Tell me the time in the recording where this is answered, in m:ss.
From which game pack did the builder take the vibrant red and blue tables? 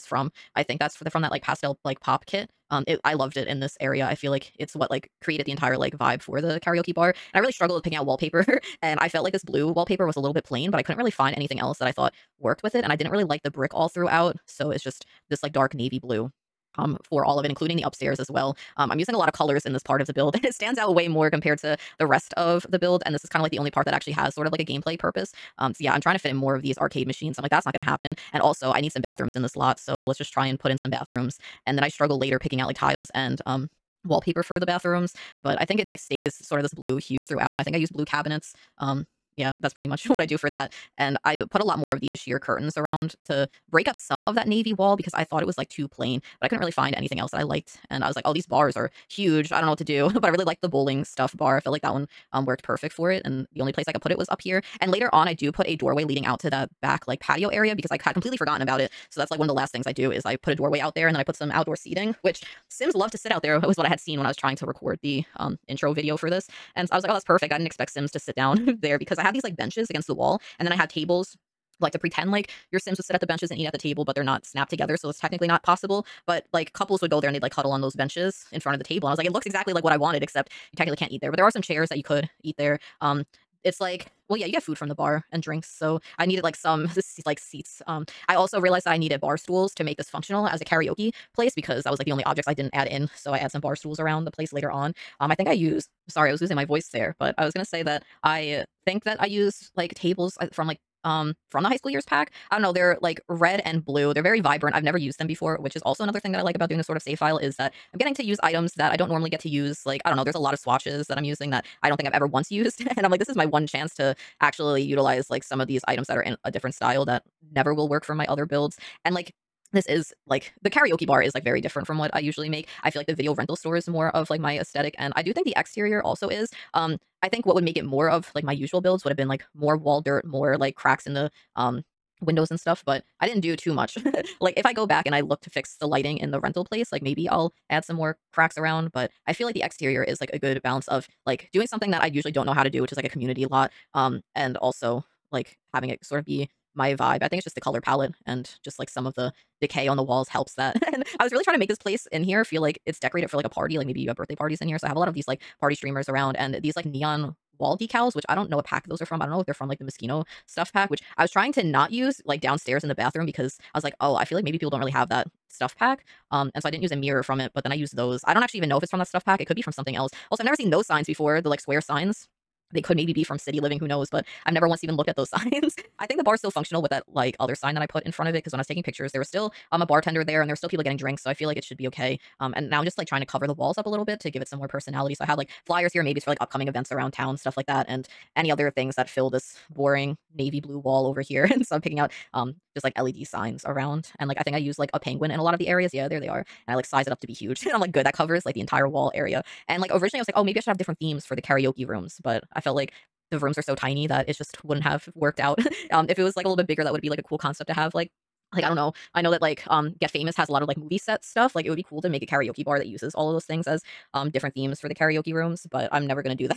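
1:41.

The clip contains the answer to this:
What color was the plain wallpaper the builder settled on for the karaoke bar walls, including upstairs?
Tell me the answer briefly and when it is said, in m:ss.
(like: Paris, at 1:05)
Dark navy blue, at 0:15.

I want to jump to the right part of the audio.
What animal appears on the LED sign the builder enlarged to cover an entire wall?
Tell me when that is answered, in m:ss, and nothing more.
3:14.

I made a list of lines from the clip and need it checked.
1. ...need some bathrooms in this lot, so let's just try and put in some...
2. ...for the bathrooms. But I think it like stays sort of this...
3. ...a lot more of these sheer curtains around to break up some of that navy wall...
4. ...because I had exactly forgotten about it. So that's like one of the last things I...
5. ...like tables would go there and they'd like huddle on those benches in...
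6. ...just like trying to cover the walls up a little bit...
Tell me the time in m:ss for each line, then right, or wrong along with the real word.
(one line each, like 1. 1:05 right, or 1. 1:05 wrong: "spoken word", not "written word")
1. 0:28 right
2. 0:34 right
3. 0:41 right
4. 0:57 wrong: "completely", not "exactly"
5. 1:16 wrong: "couples", not "tables"
6. 3:02 right.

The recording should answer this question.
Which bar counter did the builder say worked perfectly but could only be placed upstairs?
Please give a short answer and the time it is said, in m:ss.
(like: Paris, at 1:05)
Bowling stuff bar, at 0:50.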